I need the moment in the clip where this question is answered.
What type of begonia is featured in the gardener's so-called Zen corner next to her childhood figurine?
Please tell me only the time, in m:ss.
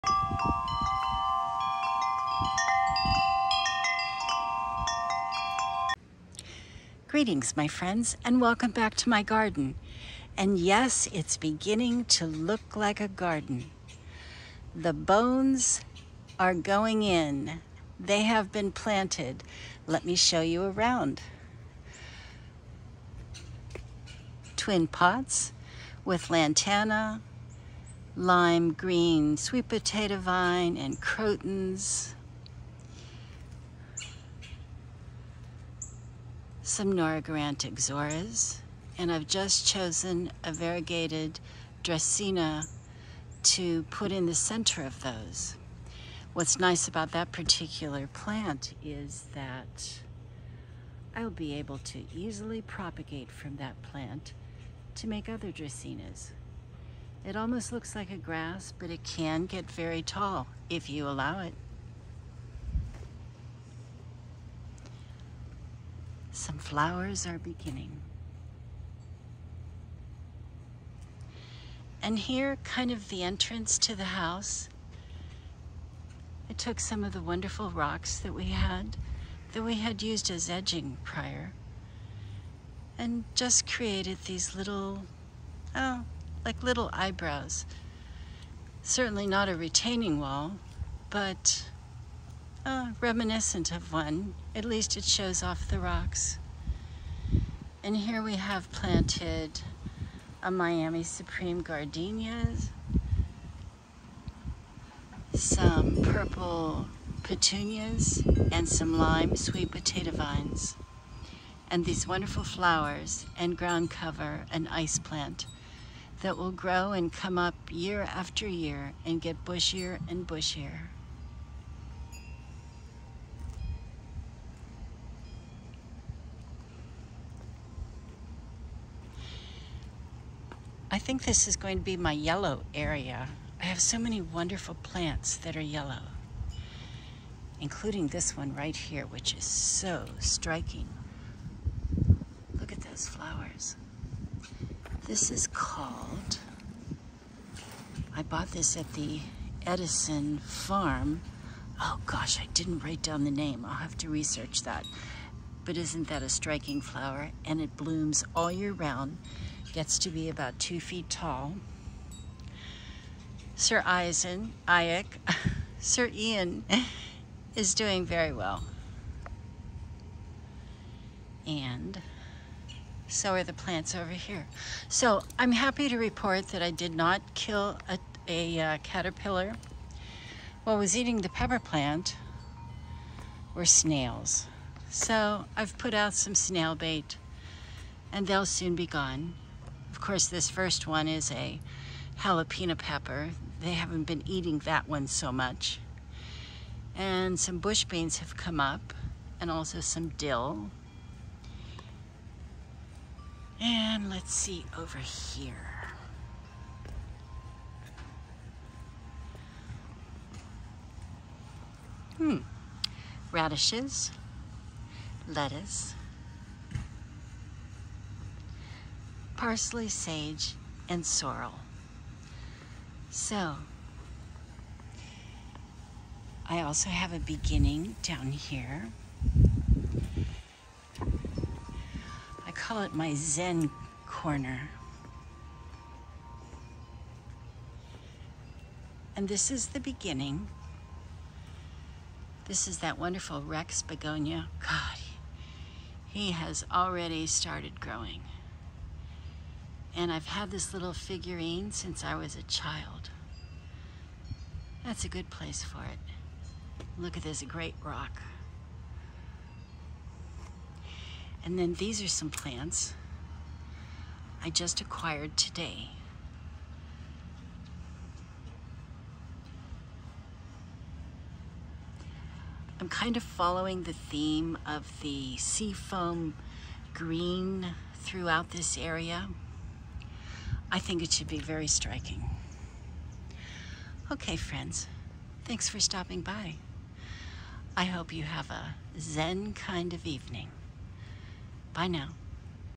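4:03.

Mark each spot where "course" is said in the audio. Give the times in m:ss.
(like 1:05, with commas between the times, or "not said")
3:10.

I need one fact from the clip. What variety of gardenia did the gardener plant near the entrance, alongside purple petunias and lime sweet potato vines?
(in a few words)
Miami Supreme.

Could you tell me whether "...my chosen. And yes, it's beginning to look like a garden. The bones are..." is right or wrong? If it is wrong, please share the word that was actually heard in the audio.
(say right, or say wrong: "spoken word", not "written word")
wrong: "garden", not "chosen".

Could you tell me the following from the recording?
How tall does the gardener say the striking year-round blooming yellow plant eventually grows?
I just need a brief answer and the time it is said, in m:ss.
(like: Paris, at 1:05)
2 feet, at 2:40.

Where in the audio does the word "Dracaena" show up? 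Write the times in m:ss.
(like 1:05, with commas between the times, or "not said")
0:41, 0:55.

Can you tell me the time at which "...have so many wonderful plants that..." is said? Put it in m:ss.
2:13.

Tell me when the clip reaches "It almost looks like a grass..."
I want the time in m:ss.
0:57.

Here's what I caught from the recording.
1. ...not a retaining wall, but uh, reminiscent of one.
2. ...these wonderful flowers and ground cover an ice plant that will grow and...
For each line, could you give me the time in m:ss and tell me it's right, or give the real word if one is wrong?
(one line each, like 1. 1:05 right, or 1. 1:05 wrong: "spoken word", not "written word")
1. 1:29 right
2. 1:51 right.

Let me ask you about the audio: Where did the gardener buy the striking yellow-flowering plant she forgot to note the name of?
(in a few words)
Edison Farm.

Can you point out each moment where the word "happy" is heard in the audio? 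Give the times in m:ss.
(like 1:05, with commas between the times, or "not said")
2:55.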